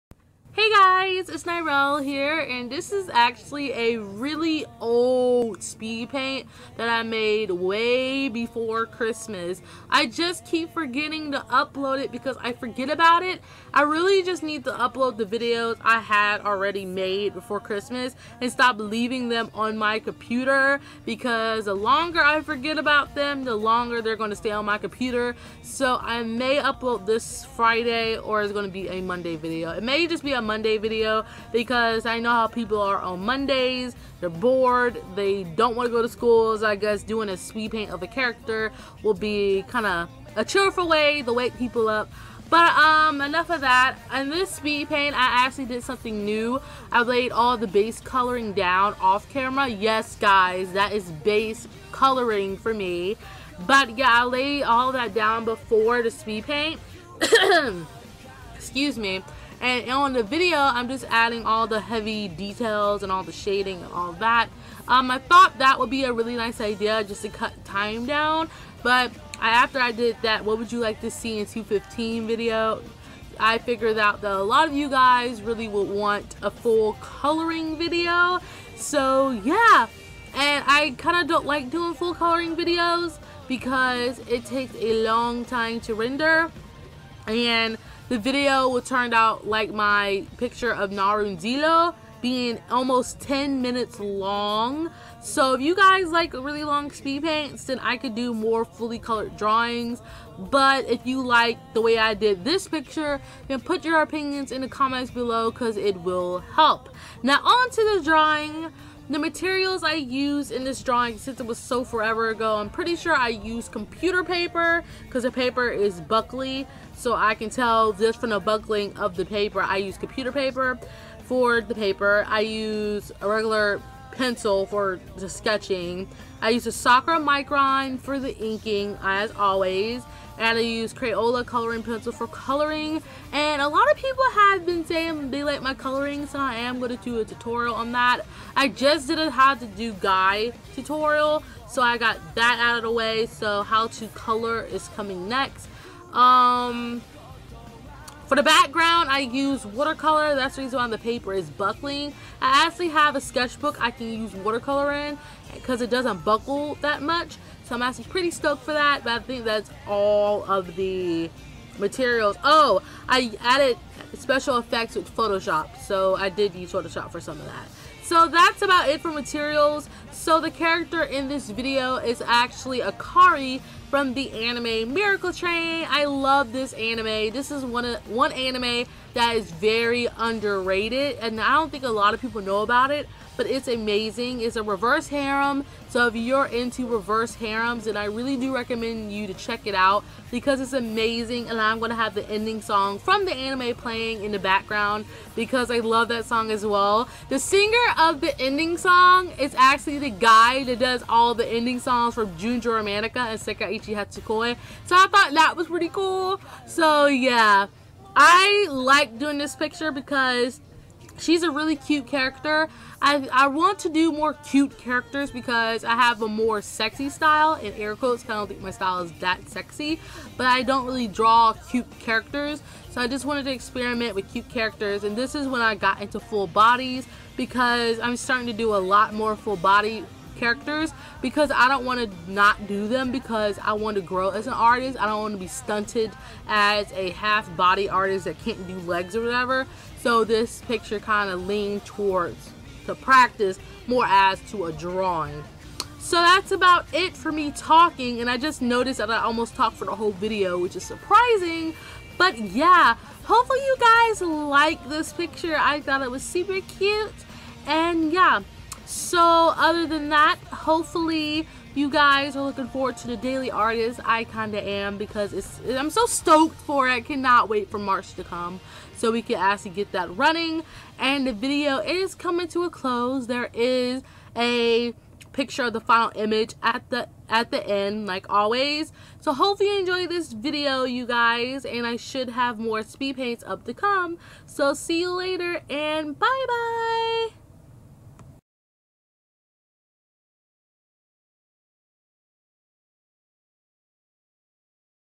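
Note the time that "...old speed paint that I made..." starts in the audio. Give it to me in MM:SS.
00:04.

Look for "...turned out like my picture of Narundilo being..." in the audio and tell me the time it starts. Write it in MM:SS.
01:28.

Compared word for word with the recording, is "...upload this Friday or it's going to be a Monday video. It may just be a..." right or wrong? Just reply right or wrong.
right.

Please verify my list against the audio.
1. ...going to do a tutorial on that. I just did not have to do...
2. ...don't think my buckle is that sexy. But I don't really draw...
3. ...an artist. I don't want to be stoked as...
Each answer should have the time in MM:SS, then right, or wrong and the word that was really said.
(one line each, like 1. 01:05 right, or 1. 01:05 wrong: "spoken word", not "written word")
1. 02:16 right
2. 03:38 wrong: "style", not "buckle"
3. 03:54 wrong: "stunted", not "stoked".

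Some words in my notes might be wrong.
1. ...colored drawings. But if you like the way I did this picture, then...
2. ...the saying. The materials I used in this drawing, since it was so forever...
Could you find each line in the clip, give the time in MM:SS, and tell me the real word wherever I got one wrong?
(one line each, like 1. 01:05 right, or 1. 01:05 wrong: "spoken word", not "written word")
1. 01:38 right
2. 01:47 wrong: "drawing", not "saying".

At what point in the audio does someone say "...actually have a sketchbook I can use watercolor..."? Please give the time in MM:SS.
02:32.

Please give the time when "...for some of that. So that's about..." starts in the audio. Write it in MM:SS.
02:47.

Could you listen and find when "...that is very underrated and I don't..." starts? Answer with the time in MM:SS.
02:59.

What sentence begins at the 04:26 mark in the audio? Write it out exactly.
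I cannot wait for March to come so we can actually get that running.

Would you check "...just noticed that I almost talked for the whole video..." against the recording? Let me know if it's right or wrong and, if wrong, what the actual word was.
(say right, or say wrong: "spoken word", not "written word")
right.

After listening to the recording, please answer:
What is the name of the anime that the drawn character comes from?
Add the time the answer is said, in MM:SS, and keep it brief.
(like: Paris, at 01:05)
Miracle Train, at 02:54.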